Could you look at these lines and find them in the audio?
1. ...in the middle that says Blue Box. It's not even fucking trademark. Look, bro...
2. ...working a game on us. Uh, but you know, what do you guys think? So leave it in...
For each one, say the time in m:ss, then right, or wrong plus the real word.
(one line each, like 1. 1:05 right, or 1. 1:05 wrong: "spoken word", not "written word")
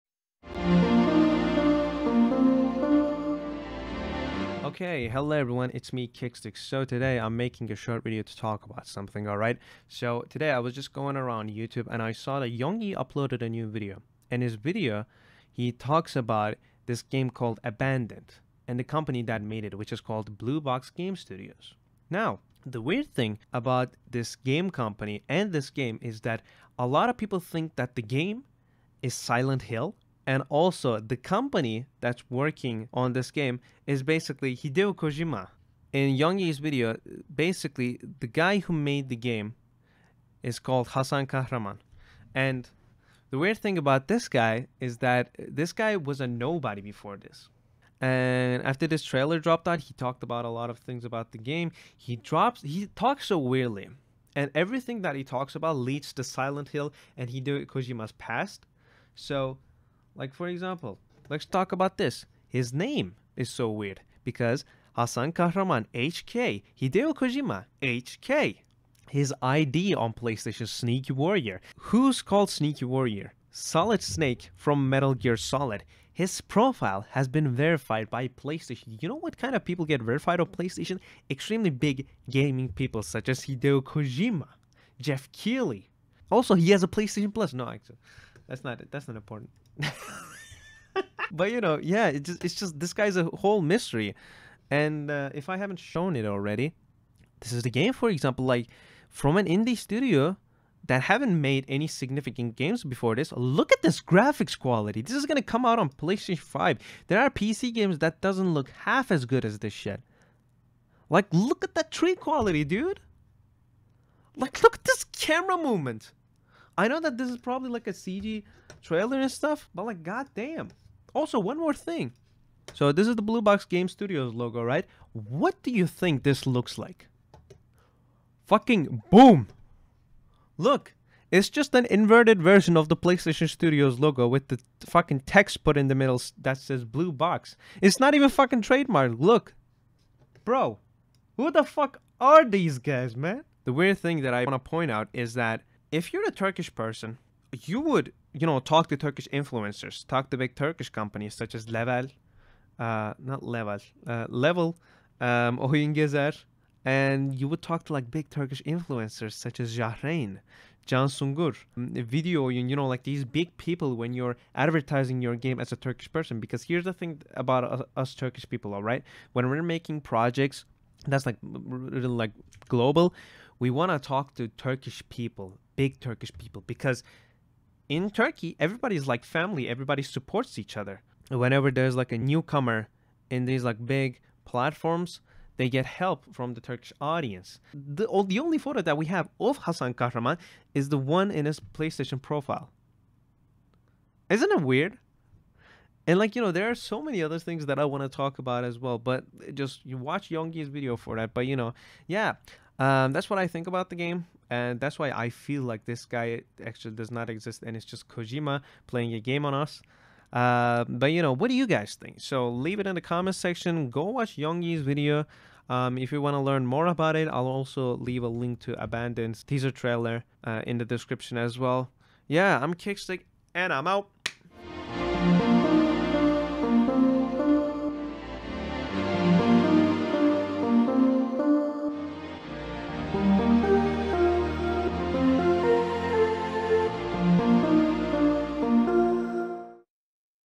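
1. 2:15 right
2. 3:28 wrong: "playing", not "working".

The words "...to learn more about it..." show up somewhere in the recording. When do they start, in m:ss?
3:36.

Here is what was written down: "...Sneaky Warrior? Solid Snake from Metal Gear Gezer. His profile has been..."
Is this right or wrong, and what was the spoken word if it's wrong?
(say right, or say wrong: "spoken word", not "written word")
wrong: "Solid", not "Gezer".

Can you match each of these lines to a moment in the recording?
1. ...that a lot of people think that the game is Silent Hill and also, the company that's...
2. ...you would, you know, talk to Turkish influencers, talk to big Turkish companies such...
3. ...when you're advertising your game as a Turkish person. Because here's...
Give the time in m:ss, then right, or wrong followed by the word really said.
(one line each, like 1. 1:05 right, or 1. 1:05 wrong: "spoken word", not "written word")
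1. 0:26 right
2. 2:27 right
3. 2:43 right.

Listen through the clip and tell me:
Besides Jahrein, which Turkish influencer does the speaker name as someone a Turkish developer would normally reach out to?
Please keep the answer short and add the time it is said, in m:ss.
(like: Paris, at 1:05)
Can Sungur, at 2:40.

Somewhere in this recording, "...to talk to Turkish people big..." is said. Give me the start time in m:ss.
2:53.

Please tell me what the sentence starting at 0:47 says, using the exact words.
And after this trailer dropped out, he talked about a lot of things about the game.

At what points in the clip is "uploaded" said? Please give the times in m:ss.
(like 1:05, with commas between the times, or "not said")
0:12.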